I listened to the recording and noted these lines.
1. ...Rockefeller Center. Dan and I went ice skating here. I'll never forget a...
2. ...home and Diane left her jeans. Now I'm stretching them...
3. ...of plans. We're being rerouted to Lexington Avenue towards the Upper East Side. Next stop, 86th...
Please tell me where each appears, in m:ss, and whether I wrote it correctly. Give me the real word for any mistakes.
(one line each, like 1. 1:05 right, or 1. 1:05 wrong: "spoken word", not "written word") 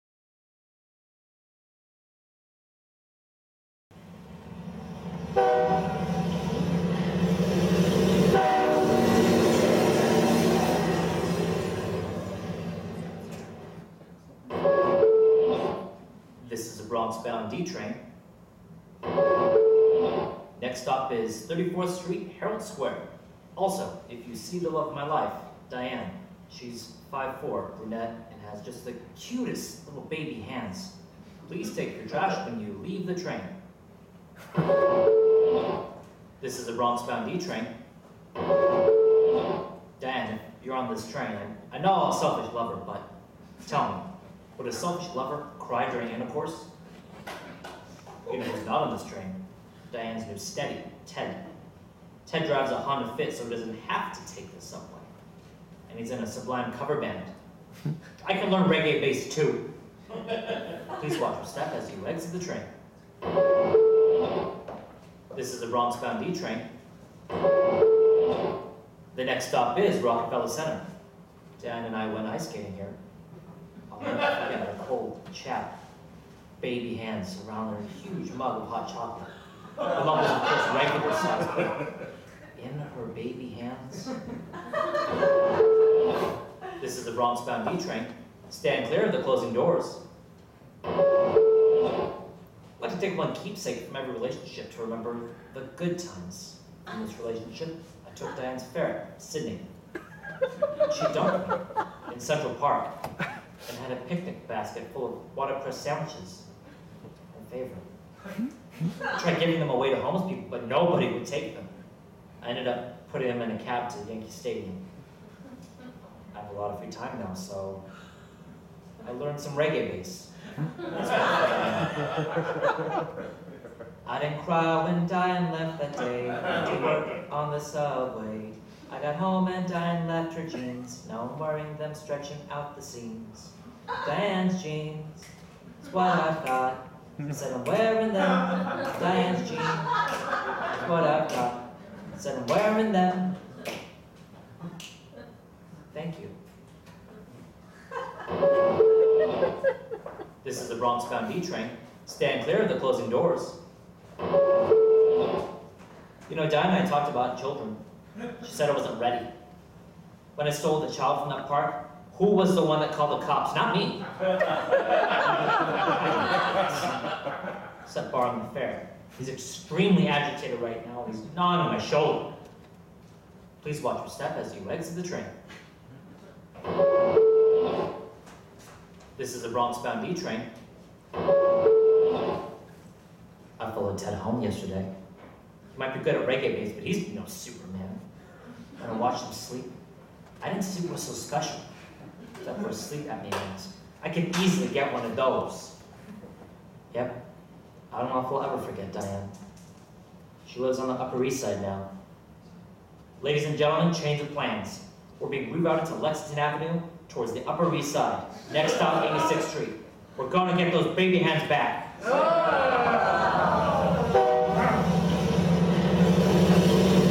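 1. 1:10 right
2. 2:09 wrong: "wearing", not "stretching"
3. 3:24 right.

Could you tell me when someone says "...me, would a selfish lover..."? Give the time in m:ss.
0:43.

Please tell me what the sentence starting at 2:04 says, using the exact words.
I didn't cry when Diane left that day.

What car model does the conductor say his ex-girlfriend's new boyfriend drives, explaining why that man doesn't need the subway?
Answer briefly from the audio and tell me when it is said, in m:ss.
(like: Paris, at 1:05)
Honda Fit, at 0:52.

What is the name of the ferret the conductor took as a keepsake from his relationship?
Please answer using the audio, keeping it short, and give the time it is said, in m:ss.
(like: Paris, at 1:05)
Sydney, at 1:39.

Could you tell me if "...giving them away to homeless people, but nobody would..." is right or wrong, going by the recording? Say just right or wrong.
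right.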